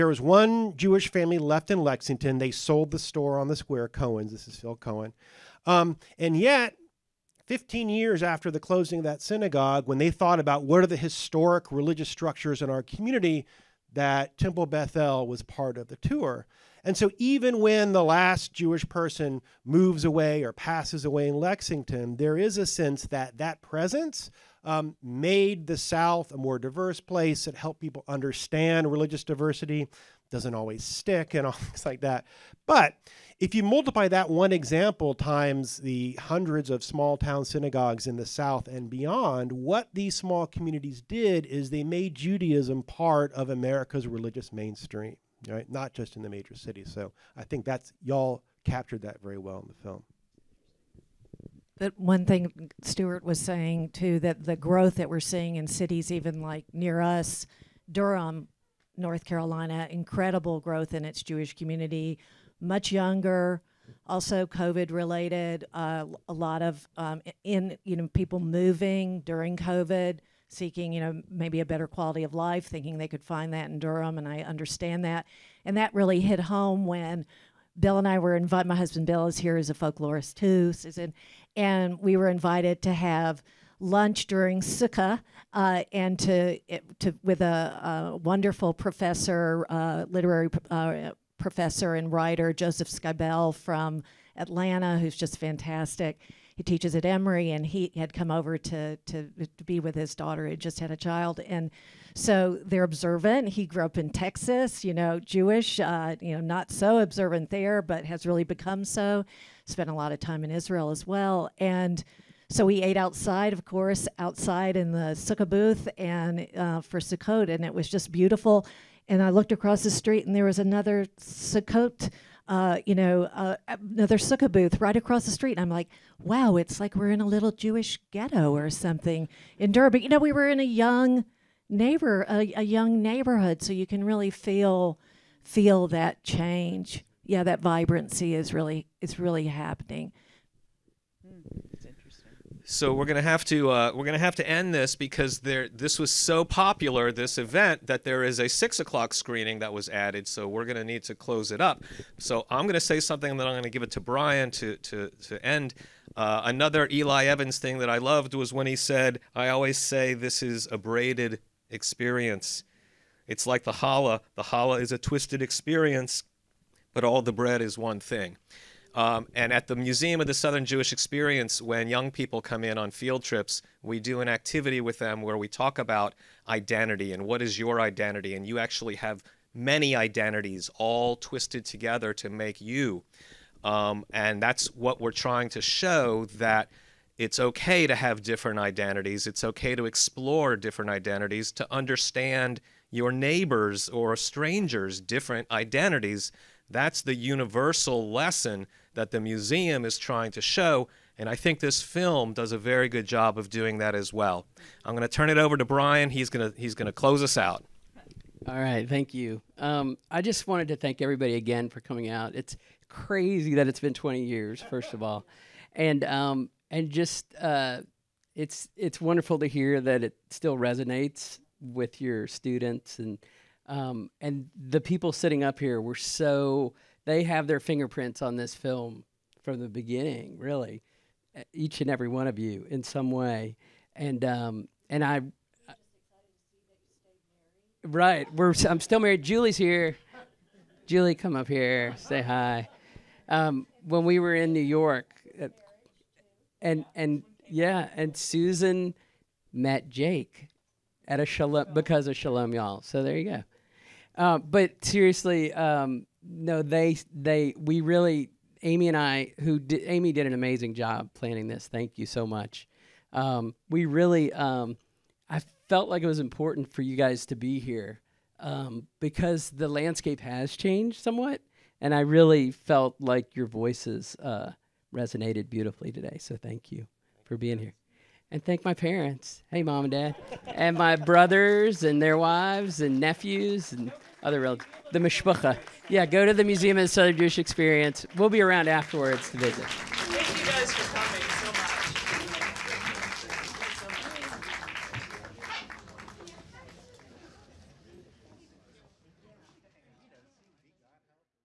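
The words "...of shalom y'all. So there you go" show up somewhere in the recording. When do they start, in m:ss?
4:12.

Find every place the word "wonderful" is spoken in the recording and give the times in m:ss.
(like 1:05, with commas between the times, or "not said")
1:28, 3:38.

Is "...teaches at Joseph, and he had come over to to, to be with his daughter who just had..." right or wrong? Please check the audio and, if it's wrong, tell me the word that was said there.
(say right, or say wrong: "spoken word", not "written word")
wrong: "Emory", not "Joseph".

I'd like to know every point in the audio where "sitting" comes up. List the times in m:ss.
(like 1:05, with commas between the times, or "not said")
3:45.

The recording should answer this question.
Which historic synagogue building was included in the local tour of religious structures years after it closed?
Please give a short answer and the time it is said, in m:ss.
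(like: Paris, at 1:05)
Temple Bethel, at 0:14.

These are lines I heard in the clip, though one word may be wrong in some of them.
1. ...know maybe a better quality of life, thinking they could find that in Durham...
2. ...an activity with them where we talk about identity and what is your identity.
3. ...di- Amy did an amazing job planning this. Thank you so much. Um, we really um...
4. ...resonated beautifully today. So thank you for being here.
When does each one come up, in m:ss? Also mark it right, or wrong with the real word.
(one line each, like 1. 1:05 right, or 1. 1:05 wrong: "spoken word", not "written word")
1. 1:11 right
2. 2:54 right
3. 4:19 right
4. 4:34 right.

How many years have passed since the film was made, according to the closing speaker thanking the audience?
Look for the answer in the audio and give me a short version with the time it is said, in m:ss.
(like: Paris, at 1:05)
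20, at 3:33.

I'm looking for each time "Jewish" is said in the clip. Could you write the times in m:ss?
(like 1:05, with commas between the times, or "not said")
0:00, 0:18, 1:01, 1:45, 2:07, 2:50, 4:47.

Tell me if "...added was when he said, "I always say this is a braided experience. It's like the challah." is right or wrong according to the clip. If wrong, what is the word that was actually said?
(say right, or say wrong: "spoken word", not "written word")
wrong: "loved", not "added".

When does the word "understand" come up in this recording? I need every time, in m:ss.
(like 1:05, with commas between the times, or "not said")
0:28, 1:14, 3:11.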